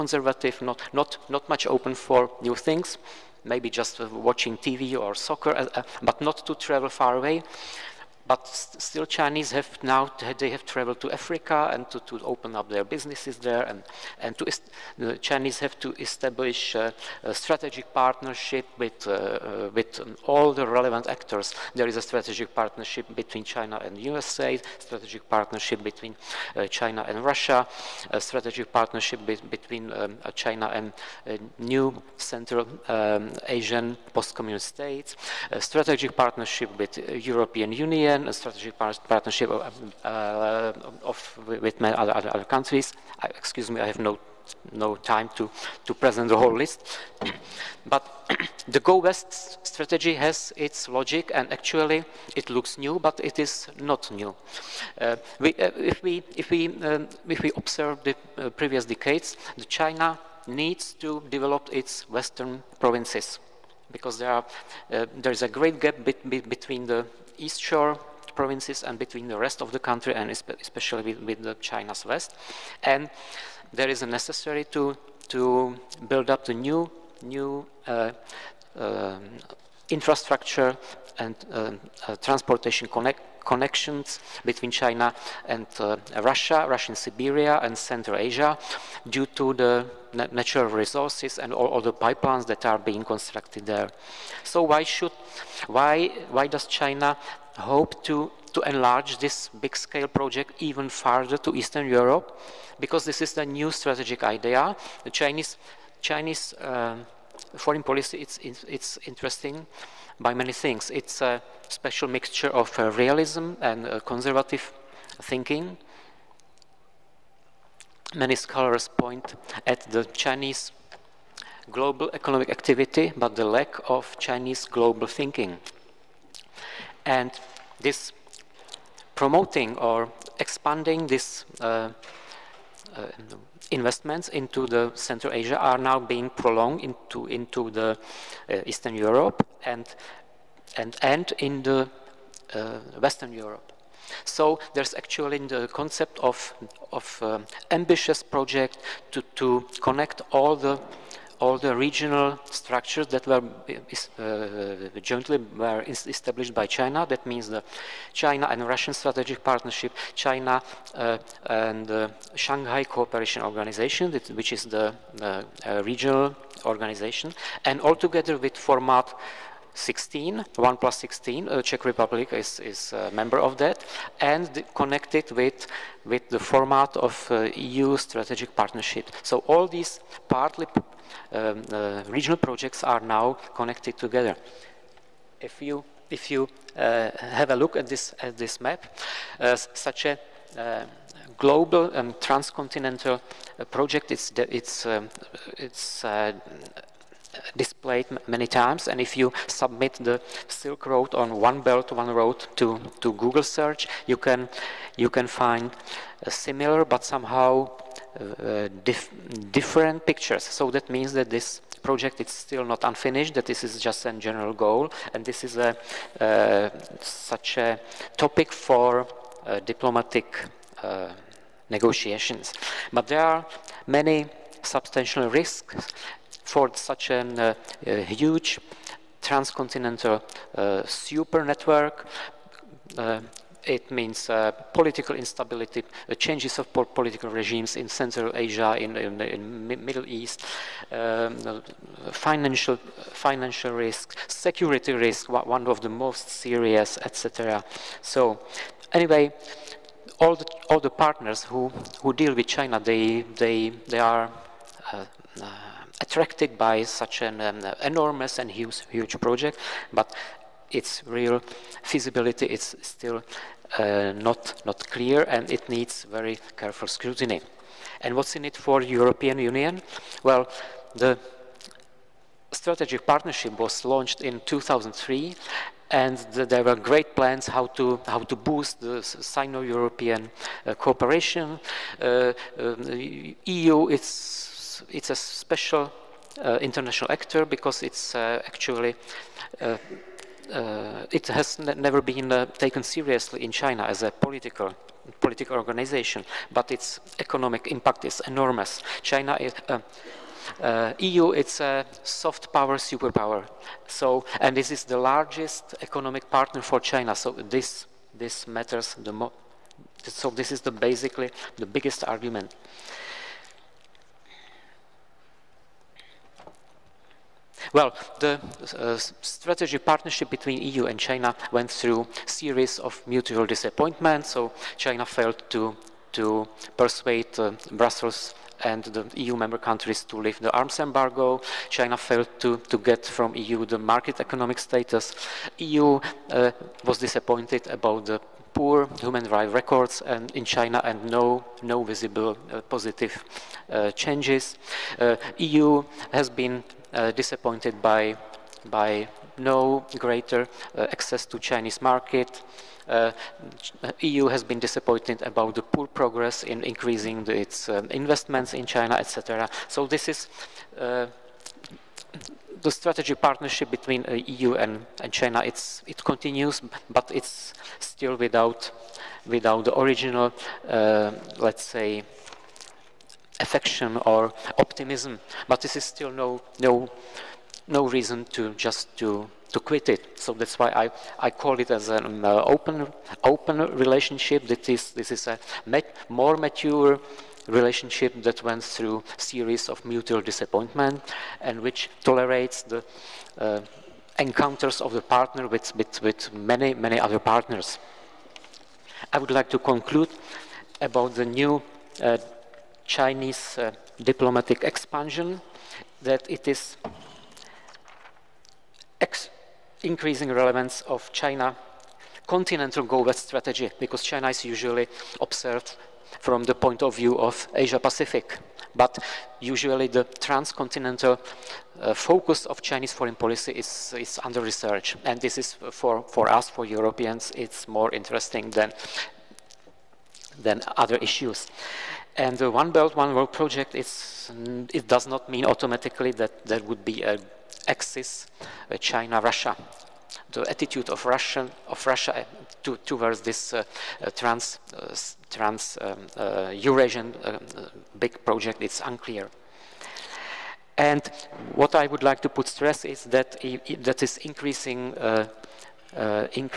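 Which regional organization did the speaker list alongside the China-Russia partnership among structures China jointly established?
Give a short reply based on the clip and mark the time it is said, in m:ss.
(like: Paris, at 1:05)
Shanghai Cooperation Organization, at 2:42.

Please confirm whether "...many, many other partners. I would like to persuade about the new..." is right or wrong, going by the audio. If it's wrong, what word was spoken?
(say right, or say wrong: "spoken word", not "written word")
wrong: "conclude", not "persuade".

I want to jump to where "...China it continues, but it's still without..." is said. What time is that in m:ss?
6:05.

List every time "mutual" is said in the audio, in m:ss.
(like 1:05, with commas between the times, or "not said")
5:23, 6:29.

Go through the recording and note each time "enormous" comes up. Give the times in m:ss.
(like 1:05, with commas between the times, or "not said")
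4:17, 4:58.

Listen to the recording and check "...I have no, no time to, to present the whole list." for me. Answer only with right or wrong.
right.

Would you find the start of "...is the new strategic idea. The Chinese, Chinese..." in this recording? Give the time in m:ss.
1:43.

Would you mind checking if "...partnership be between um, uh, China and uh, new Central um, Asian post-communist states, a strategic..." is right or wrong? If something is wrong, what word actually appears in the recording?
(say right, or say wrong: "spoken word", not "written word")
right.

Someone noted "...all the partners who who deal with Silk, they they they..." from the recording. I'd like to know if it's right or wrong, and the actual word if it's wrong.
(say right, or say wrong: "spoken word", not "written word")
wrong: "China", not "Silk".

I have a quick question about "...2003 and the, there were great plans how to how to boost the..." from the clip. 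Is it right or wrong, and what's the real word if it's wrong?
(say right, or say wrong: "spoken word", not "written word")
right.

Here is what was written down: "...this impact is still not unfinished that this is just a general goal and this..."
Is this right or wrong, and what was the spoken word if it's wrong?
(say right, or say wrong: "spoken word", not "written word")
wrong: "project", not "impact".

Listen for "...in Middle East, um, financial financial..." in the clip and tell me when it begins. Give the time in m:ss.
3:59.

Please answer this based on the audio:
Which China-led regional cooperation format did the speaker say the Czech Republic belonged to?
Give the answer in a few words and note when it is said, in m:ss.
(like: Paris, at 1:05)
1 plus 16, at 2:50.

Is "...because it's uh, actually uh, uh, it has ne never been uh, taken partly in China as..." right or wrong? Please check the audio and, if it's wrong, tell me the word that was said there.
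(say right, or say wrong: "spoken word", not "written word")
wrong: "seriously", not "partly".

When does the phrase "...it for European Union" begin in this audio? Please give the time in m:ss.
4:28.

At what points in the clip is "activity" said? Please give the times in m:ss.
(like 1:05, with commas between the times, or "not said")
2:02.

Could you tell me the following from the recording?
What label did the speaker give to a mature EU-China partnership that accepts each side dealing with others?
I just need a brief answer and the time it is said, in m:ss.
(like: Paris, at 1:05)
open relationship, at 6:22.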